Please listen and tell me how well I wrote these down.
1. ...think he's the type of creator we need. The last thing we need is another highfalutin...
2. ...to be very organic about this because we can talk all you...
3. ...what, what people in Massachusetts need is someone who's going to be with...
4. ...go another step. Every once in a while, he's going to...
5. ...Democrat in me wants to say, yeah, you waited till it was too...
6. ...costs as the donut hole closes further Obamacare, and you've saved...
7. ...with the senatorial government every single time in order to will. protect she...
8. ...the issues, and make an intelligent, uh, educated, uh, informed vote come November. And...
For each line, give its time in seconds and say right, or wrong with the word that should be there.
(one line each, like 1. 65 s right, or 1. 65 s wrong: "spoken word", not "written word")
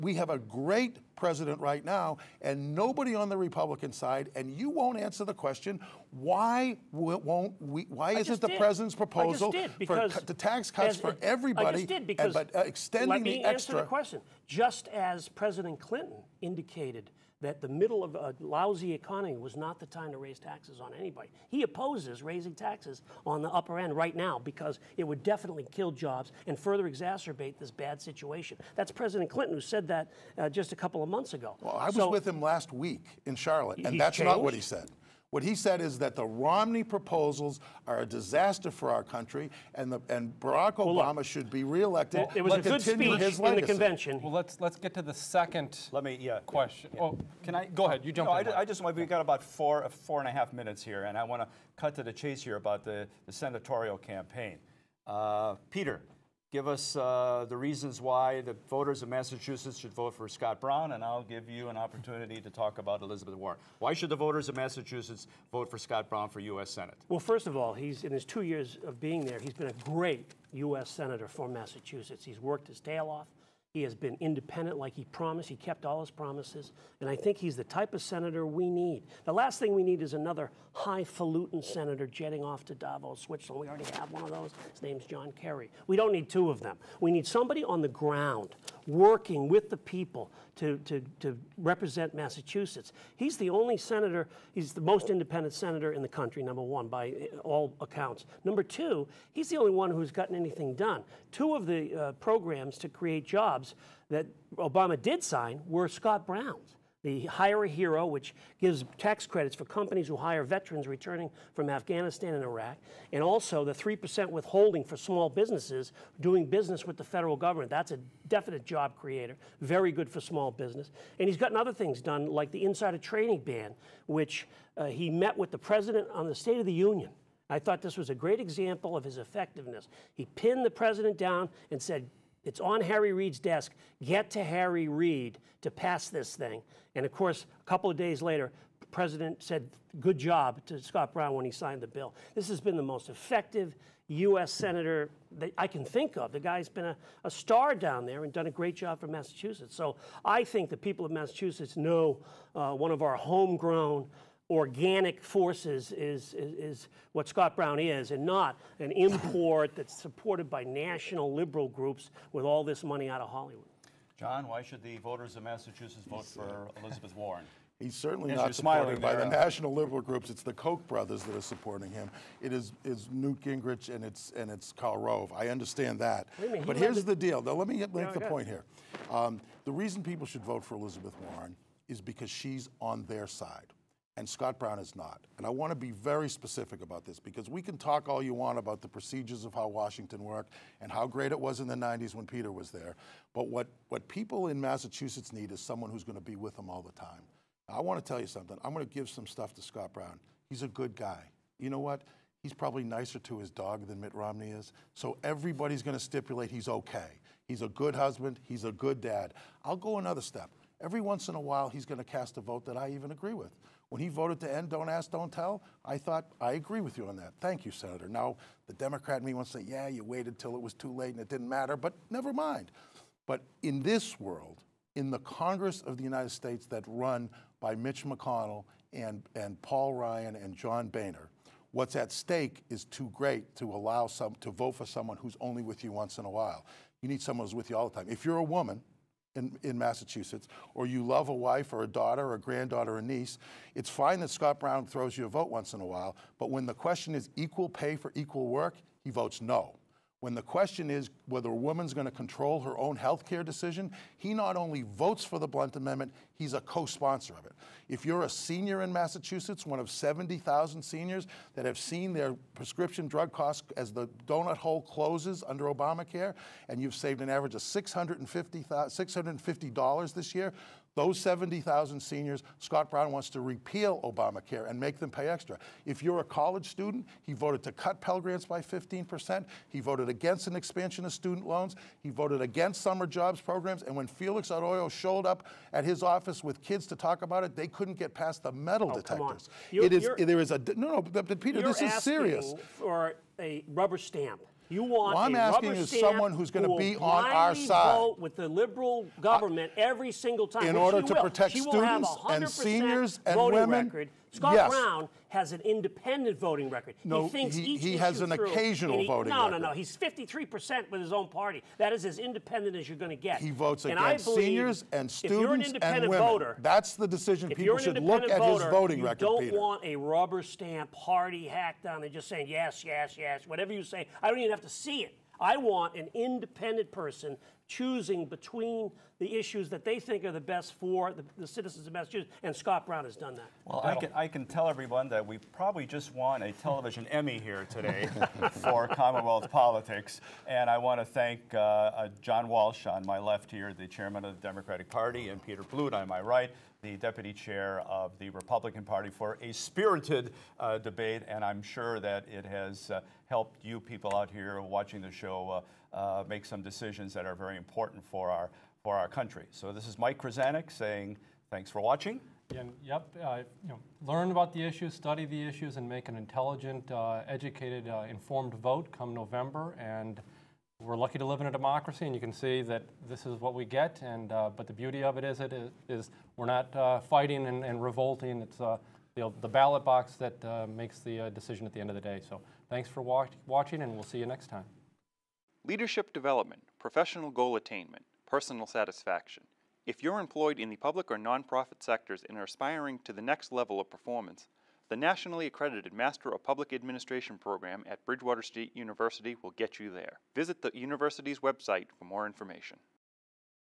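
1. 77 s wrong: "senator", not "creator"
2. 185 s wrong: "specific", not "organic"
3. 193 s right
4. 209 s right
5. 218 s right
6. 263 s wrong: "under", not "further"
7. 298 s wrong: "liberal", not "senatorial"
8. 365 s right.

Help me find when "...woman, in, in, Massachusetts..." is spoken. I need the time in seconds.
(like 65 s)
238 s.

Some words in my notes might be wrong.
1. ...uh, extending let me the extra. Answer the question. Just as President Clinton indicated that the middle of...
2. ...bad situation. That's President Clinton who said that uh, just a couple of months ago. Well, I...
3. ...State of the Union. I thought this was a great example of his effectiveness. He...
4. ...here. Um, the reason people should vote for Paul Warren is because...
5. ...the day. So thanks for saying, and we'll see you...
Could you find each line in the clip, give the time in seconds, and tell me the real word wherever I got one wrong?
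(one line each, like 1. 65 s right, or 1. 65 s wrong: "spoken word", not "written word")
1. 12 s right
2. 27 s right
3. 126 s right
4. 178 s wrong: "Elizabeth", not "Paul"
5. 381 s wrong: "watching", not "saying".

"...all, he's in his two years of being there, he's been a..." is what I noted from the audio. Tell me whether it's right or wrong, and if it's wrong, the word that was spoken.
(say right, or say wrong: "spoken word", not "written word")
right.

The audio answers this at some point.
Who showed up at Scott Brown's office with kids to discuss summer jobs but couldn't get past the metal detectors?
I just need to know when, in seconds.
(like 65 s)
284 s.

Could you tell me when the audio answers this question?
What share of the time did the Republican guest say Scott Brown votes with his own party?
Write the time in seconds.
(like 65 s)
309 s.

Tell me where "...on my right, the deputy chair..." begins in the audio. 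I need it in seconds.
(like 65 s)
345 s.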